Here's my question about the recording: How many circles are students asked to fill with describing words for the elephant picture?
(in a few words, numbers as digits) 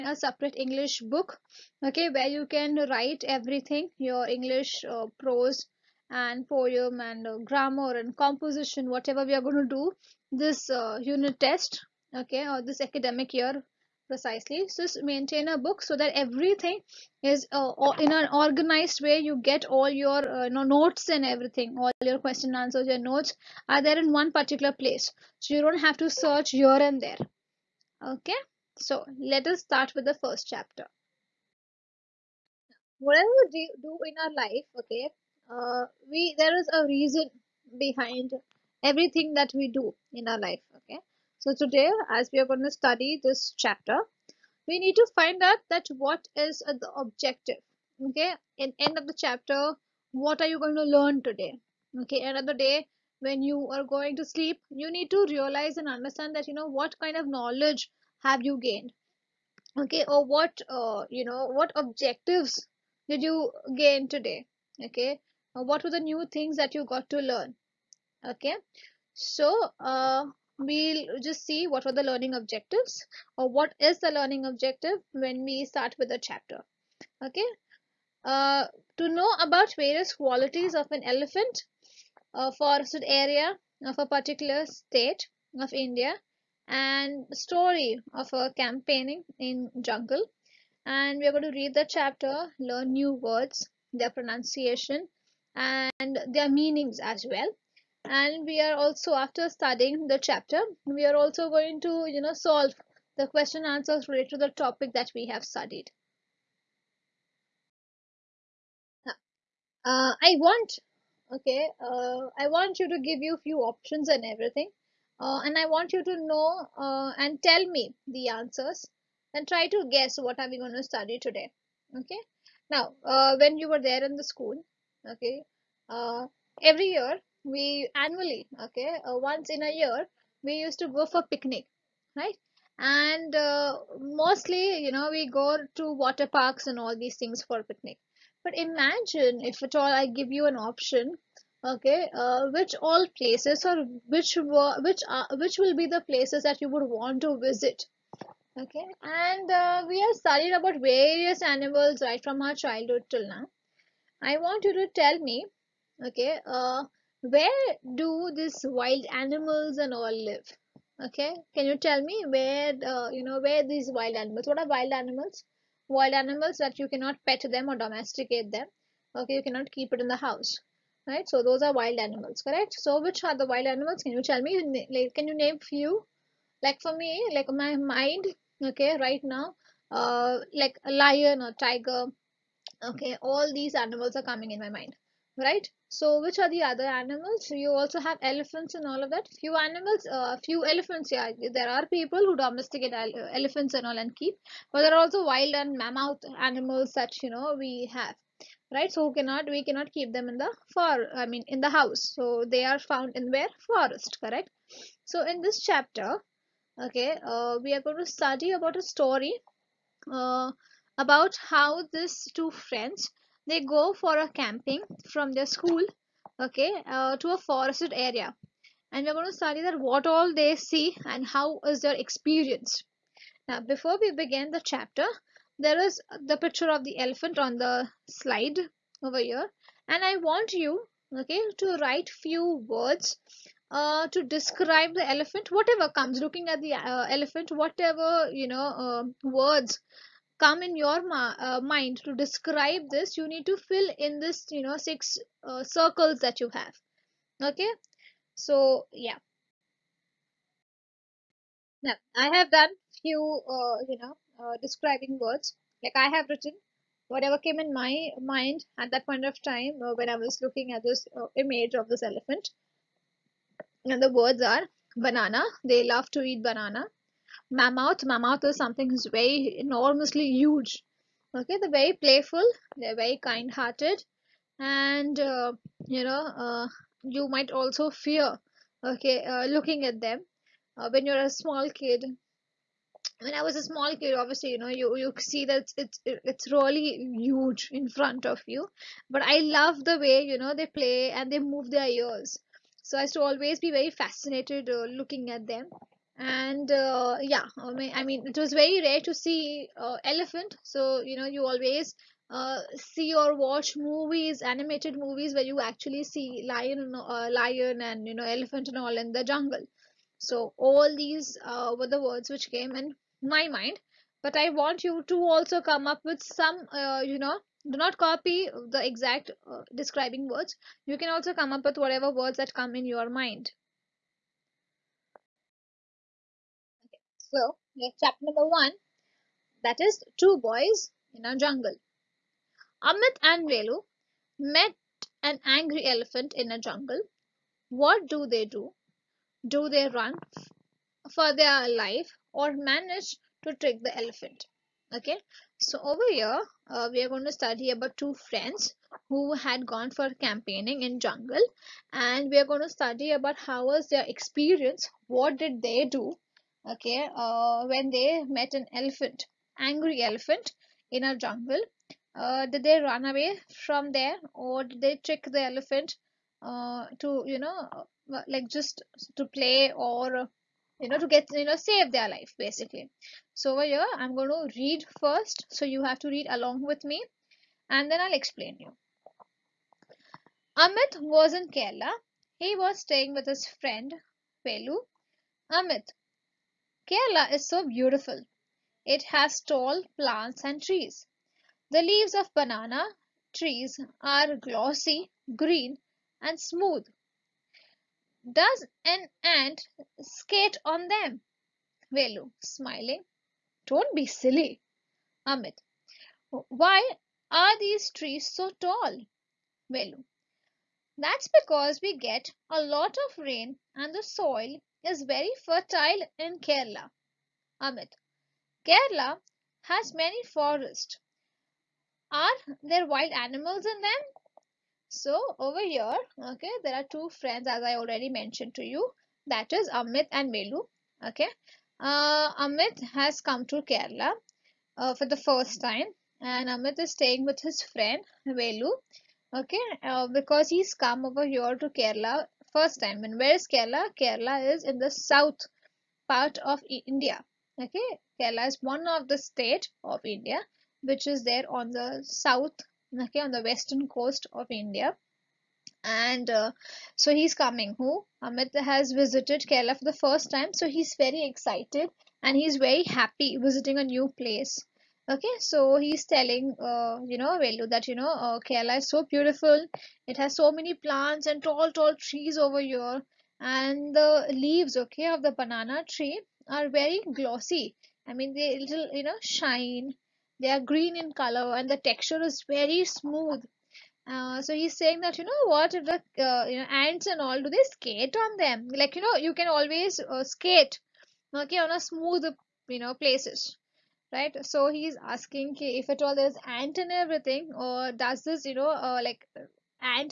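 6.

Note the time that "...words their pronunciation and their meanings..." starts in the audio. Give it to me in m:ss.
1:33.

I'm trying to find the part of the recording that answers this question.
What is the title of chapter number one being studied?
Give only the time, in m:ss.
5:30.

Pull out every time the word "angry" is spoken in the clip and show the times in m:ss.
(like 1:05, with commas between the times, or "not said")
5:35, 5:59.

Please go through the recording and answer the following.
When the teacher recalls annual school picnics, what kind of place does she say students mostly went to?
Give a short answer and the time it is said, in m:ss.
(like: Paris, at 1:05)
Water parks, at 2:16.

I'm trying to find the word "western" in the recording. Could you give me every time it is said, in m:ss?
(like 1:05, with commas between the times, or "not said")
7:33.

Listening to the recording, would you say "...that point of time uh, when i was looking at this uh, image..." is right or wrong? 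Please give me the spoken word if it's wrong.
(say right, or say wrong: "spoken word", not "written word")
right.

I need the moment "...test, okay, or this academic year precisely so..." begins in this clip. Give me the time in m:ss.
0:11.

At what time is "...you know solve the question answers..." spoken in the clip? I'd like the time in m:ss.
1:42.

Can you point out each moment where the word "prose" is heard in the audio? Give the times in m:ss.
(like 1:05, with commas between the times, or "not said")
0:05.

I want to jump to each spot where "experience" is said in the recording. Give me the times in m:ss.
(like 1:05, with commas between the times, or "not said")
3:42, 5:54.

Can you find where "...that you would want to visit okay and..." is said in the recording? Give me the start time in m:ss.
2:26.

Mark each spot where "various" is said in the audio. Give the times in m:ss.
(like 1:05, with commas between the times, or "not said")
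1:19, 2:30.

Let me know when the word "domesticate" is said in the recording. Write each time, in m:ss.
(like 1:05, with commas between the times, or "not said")
2:47, 3:12.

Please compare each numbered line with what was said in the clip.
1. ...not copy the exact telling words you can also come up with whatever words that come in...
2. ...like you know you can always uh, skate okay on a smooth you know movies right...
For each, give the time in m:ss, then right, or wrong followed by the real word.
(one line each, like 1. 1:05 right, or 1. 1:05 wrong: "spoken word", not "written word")
1. 5:17 wrong: "describing", not "telling"
2. 8:08 wrong: "places", not "movies".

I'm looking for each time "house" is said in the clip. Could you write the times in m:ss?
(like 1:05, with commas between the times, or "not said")
2:50, 3:21.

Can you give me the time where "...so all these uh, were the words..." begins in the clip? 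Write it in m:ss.
5:10.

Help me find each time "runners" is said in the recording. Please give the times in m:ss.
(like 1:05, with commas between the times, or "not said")
not said.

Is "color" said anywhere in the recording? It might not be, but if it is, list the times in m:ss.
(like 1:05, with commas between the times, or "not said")
8:01.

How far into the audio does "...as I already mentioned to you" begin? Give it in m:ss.
7:07.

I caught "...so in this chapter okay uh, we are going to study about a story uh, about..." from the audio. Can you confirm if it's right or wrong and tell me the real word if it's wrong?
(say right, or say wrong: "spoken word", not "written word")
right.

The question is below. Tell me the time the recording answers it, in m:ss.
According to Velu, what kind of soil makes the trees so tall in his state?
6:55.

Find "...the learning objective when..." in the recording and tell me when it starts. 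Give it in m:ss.
1:13.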